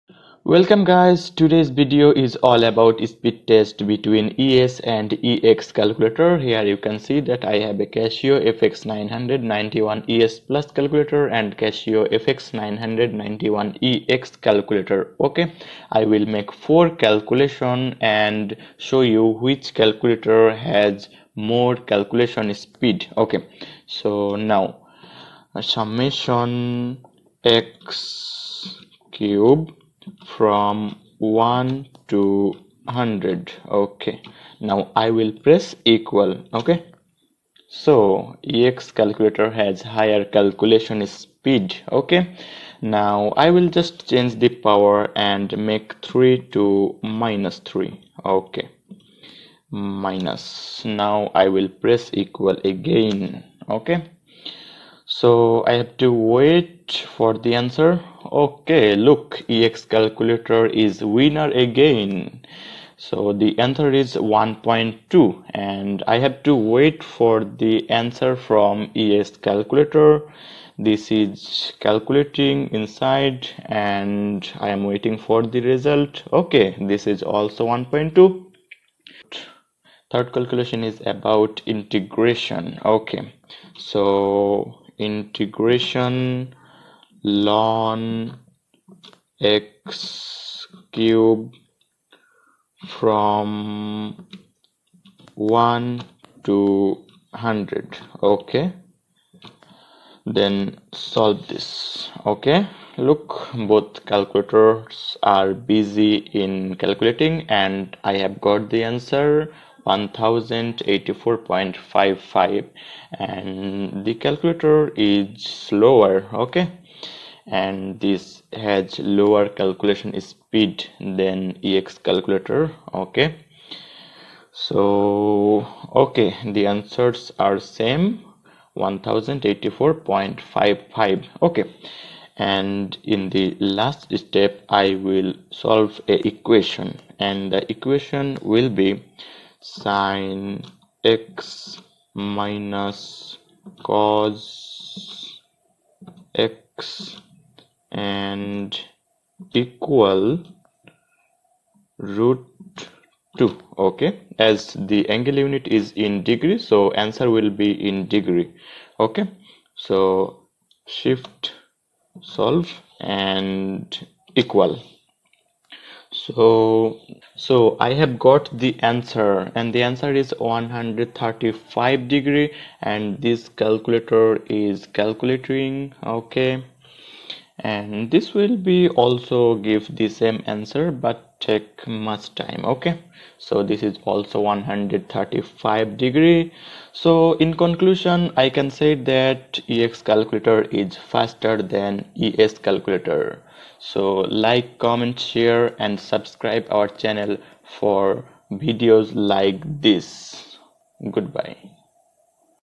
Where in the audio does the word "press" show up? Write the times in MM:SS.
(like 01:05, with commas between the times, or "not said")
00:35, 00:51.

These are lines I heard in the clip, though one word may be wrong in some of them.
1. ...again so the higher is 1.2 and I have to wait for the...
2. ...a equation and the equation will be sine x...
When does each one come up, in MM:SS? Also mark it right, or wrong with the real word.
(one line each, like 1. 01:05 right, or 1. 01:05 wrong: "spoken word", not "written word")
1. 01:01 wrong: "answer", not "higher"
2. 02:16 right.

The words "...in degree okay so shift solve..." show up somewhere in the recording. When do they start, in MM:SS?
02:37.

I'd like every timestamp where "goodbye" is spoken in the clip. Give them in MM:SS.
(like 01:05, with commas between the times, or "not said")
03:21.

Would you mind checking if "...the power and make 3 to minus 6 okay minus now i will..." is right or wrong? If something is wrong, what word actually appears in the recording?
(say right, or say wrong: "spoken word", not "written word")
wrong: "3", not "6".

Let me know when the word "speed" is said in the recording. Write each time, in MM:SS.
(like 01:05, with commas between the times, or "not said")
00:03, 00:22, 00:41, 02:00.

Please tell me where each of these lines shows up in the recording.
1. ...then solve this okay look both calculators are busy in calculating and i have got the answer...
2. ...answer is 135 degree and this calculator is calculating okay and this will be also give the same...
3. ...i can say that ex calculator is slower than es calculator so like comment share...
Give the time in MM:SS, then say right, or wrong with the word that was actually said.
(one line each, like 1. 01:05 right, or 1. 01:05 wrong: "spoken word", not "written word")
1. 01:40 right
2. 02:49 right
3. 03:08 wrong: "faster", not "slower".